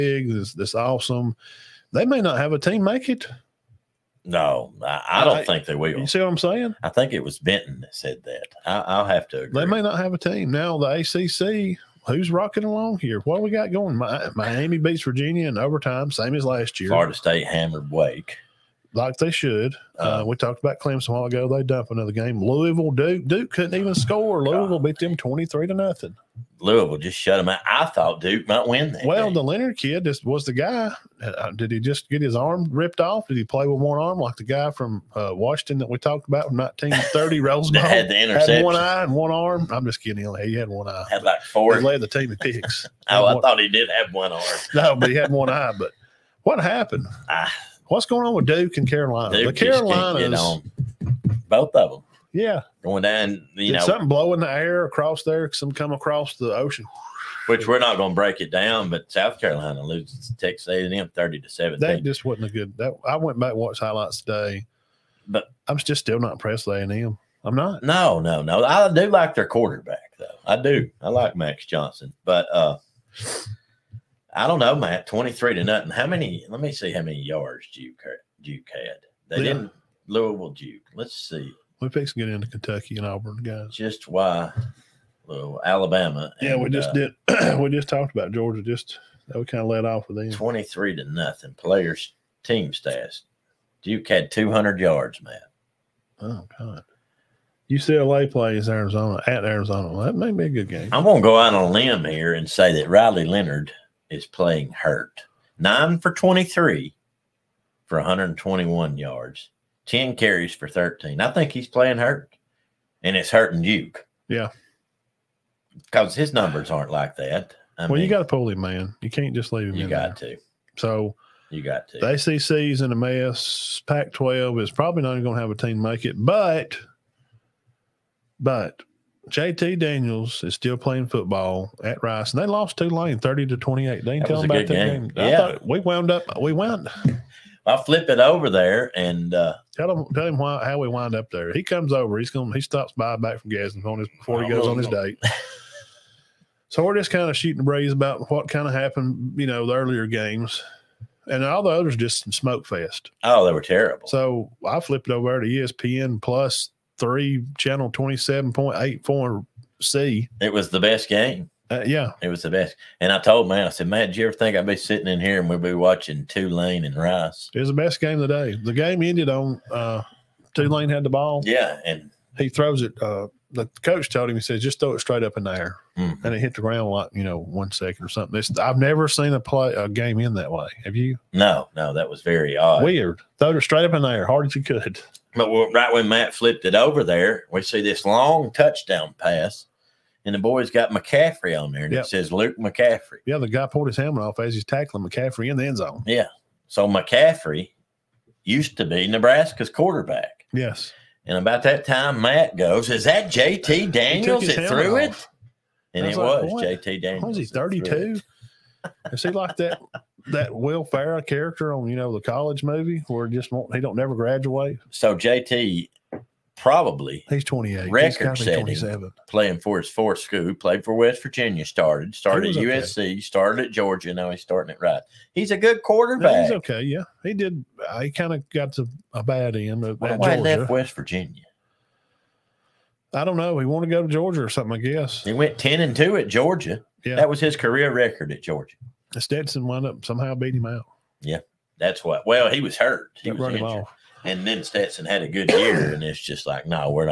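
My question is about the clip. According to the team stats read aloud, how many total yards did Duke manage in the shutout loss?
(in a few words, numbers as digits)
200.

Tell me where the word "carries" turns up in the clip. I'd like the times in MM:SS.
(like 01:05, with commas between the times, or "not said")
01:50.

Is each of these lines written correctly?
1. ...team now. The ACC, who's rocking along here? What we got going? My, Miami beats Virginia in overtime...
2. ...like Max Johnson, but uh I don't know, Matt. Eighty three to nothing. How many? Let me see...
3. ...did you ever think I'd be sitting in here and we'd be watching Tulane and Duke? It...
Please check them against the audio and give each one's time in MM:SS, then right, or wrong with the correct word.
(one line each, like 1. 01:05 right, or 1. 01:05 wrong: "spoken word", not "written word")
1. 00:10 right
2. 01:11 wrong: "Twenty", not "Eighty"
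3. 02:44 wrong: "Rice", not "Duke".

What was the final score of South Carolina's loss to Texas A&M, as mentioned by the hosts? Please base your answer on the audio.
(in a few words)
30 to 17.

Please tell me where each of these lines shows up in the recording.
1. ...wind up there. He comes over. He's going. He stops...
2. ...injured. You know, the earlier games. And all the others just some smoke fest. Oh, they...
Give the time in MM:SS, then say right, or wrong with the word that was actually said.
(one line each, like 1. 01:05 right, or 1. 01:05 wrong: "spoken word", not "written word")
1. 02:20 right
2. 02:28 wrong: "happened", not "injured".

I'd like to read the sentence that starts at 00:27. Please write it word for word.
I thought Duke might win that.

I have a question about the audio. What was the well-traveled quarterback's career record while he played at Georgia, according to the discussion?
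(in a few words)
10 and 2.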